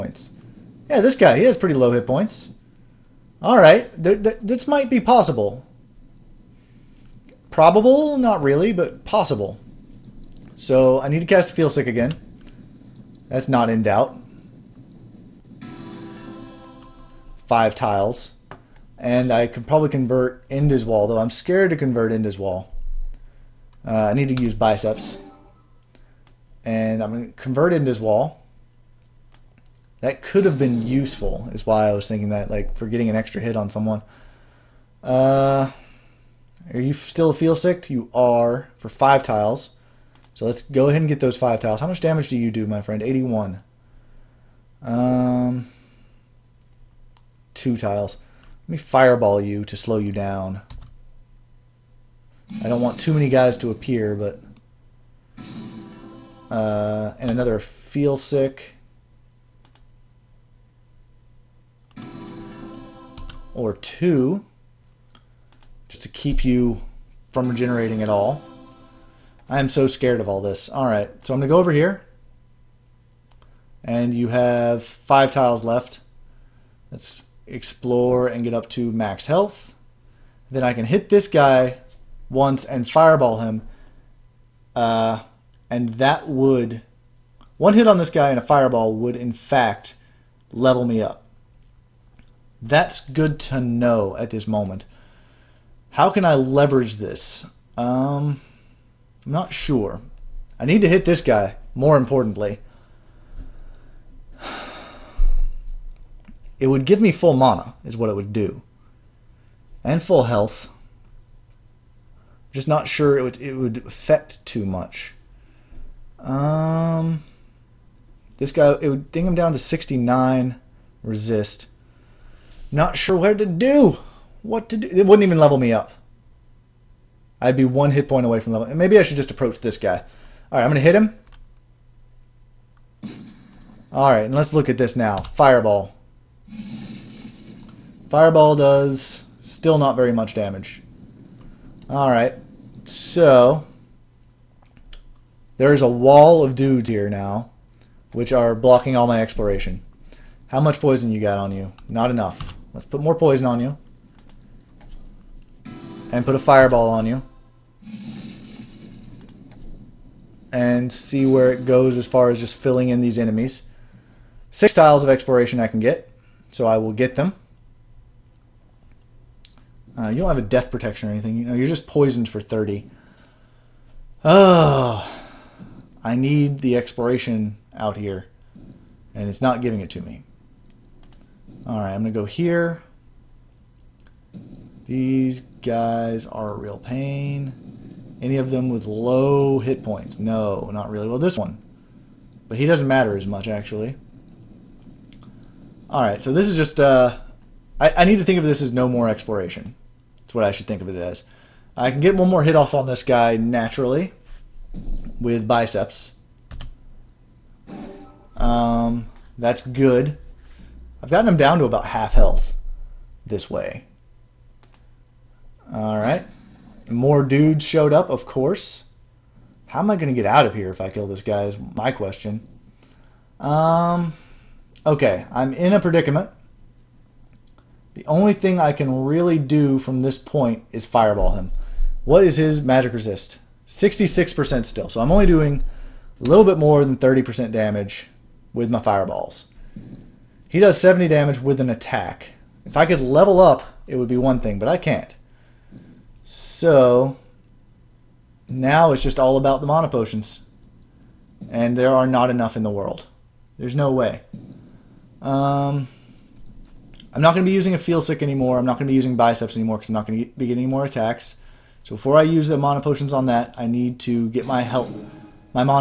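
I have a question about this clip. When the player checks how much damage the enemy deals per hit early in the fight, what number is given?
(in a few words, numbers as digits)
81.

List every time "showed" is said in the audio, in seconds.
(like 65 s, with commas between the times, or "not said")
217 s.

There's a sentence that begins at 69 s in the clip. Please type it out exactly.
I am so scared of all this.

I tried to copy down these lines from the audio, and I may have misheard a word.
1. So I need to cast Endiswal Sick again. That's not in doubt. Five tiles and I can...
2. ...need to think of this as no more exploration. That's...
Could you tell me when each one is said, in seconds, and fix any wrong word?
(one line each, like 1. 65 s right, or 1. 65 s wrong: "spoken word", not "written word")
1. 10 s wrong: "Feel", not "Endiswal"
2. 198 s right.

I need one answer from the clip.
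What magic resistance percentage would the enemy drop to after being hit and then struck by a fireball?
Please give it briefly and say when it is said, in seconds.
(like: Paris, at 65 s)
69, at 119 s.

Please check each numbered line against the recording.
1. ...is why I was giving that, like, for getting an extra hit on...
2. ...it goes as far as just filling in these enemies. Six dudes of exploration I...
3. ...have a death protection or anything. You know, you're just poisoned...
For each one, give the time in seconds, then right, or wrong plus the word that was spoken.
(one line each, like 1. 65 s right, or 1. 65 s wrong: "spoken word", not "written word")
1. 31 s wrong: "thinking", not "giving"
2. 161 s wrong: "tiles", not "dudes"
3. 170 s right.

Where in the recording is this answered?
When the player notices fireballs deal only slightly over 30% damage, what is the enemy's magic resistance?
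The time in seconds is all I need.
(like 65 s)
233 s.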